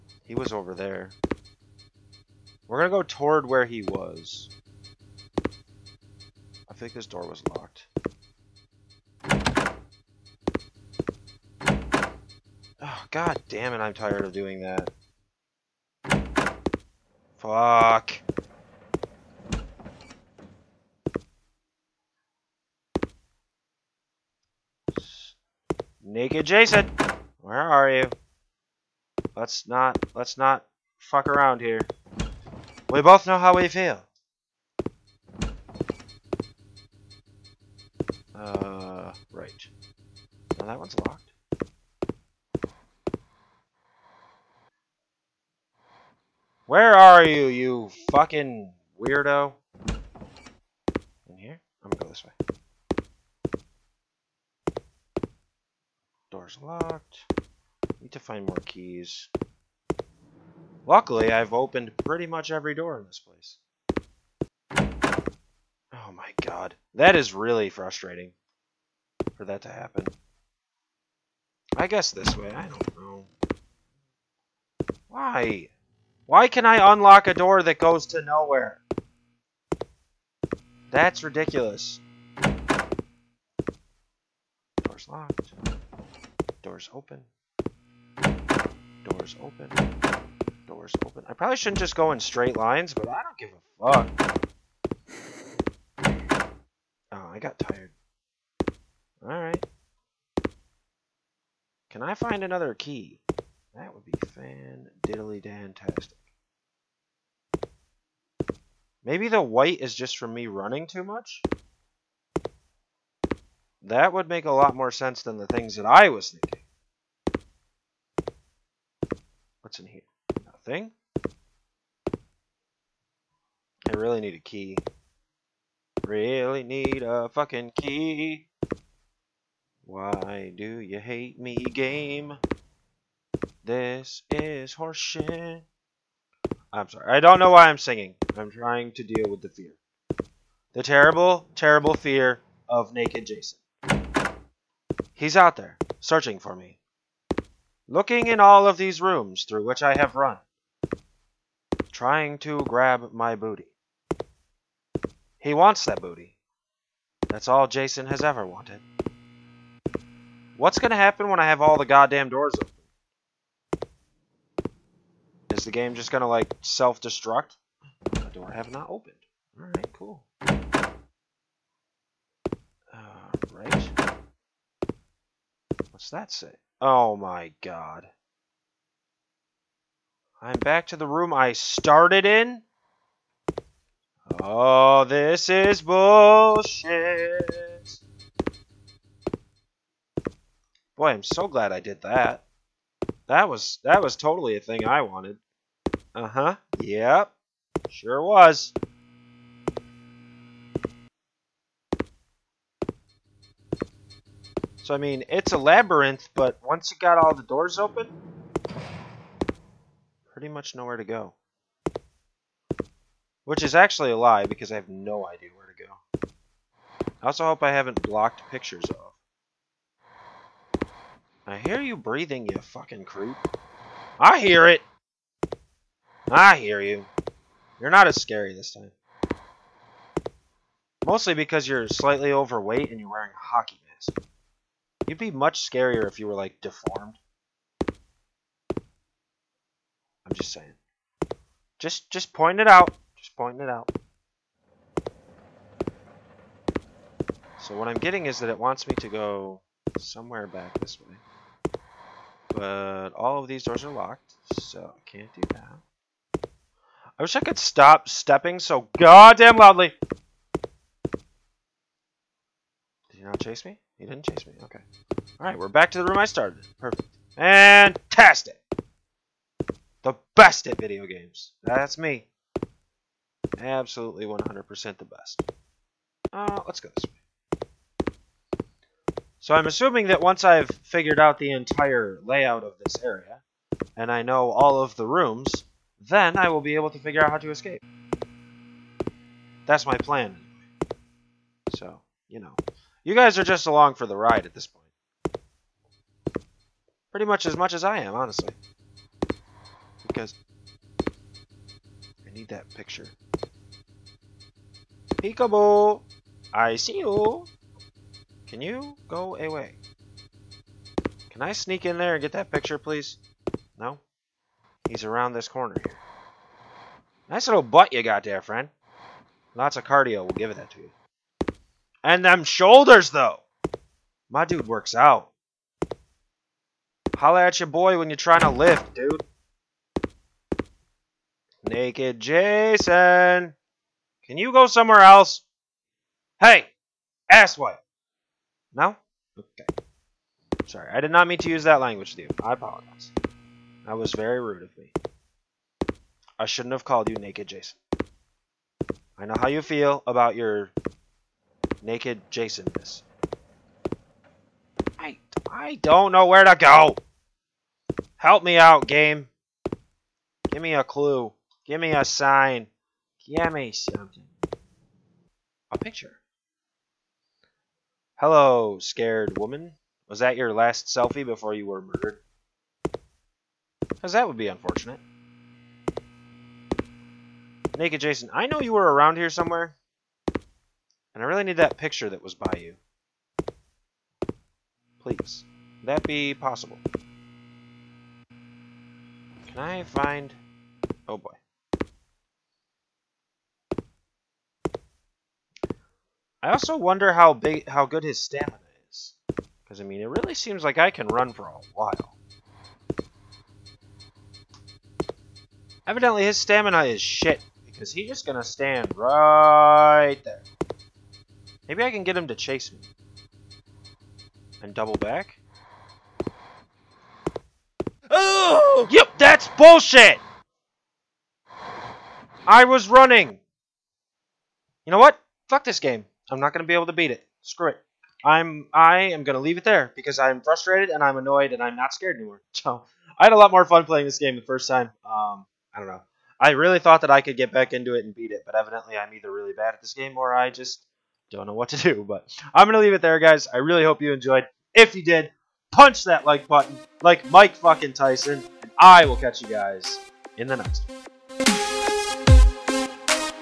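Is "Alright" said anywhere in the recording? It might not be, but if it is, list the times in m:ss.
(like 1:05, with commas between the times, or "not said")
1:39, 2:49, 4:25.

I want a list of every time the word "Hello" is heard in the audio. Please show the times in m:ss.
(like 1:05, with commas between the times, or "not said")
6:08.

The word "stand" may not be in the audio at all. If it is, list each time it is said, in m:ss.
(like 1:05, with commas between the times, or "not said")
6:48.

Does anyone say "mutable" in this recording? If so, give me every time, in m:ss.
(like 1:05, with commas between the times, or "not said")
not said.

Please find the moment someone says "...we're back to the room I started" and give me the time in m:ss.
4:25.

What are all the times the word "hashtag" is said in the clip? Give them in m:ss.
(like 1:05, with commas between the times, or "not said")
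not said.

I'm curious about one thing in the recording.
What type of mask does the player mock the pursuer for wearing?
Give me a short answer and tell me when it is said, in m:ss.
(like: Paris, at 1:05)
Hockey mask, at 3:53.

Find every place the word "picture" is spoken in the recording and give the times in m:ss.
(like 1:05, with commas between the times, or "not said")
3:38, 5:02, 5:12, 6:05, 6:21.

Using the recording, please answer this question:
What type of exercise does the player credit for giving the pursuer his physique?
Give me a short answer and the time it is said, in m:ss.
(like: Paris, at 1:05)
Cardio, at 5:19.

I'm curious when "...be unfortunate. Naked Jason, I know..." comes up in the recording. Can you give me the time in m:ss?
6:14.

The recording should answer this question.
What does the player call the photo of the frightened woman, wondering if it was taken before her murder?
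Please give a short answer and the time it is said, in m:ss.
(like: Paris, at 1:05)
Last selfie, at 6:10.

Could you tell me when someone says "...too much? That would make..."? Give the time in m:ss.
1:50.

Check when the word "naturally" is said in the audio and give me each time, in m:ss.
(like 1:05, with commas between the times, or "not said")
not said.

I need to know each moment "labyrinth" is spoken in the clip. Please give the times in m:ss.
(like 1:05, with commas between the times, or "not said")
3:25.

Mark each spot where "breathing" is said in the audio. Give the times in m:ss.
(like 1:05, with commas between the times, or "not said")
3:41.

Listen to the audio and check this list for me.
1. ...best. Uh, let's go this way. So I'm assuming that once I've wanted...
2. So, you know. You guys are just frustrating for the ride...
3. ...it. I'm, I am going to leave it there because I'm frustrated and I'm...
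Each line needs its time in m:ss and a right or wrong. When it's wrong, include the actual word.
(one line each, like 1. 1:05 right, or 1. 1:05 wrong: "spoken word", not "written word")
1. 4:35 wrong: "figured", not "wanted"
2. 4:51 wrong: "along", not "frustrating"
3. 7:07 right.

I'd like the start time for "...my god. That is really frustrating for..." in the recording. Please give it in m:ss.
1:06.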